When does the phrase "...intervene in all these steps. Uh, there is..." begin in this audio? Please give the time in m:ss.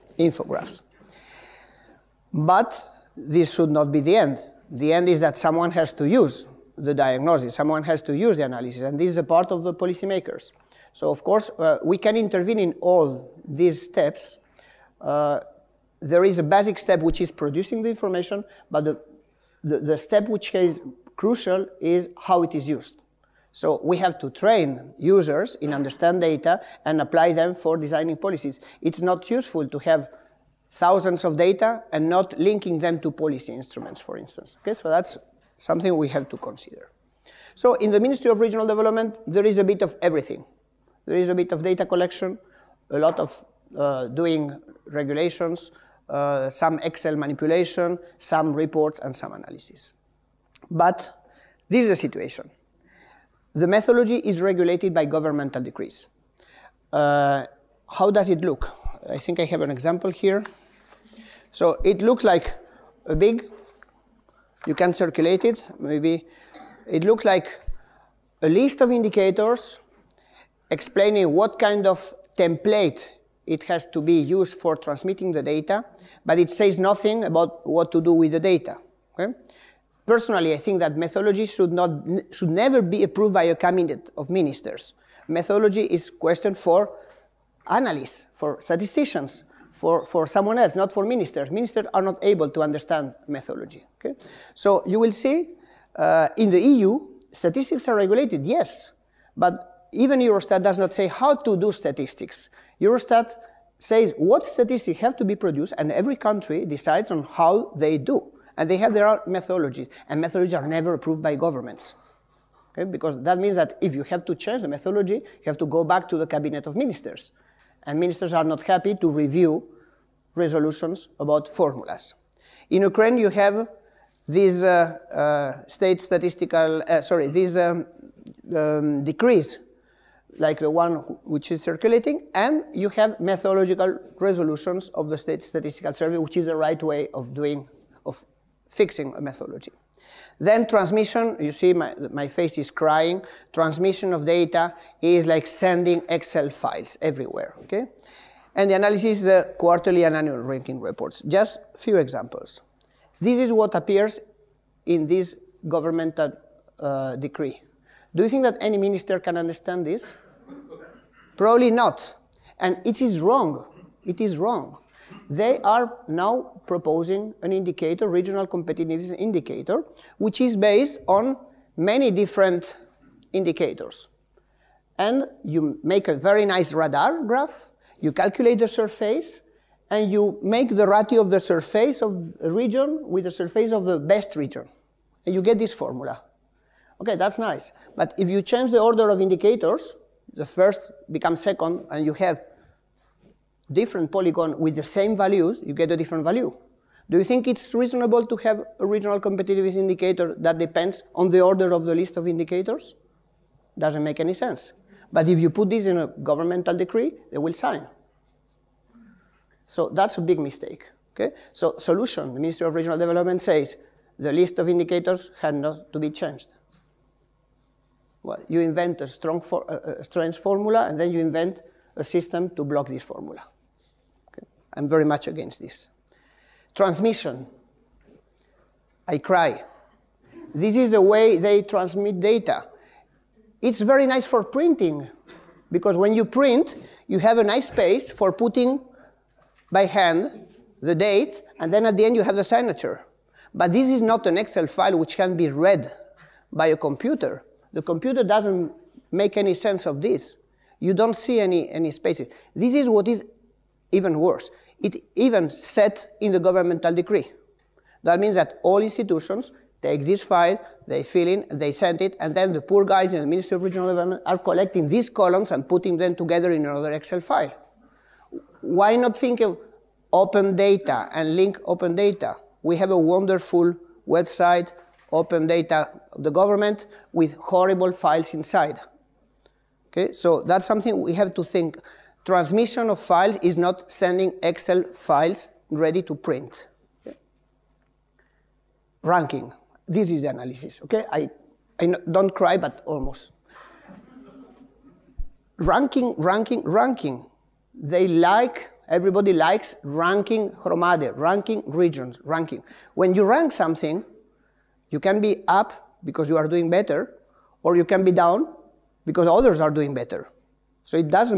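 0:12.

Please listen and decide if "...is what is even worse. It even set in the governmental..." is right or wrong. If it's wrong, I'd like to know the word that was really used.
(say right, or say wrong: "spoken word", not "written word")
right.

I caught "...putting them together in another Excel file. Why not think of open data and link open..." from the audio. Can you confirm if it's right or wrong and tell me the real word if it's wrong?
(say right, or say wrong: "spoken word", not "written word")
right.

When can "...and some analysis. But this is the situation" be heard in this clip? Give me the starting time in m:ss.
0:48.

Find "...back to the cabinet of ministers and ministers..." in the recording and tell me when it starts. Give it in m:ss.
1:55.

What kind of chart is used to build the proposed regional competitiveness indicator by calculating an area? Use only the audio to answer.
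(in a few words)
radar graph.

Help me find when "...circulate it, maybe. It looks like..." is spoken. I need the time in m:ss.
1:04.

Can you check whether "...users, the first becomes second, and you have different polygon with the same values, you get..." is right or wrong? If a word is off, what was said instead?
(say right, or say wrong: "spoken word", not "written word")
wrong: "indicators", not "users".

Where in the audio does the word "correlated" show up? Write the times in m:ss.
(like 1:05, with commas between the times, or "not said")
not said.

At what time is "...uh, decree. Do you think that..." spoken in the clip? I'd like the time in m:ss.
2:36.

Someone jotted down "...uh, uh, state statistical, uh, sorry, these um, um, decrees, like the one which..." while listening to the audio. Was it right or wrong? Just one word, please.
right.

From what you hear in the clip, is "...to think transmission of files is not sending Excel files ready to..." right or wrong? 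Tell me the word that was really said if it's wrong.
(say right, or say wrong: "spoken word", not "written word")
right.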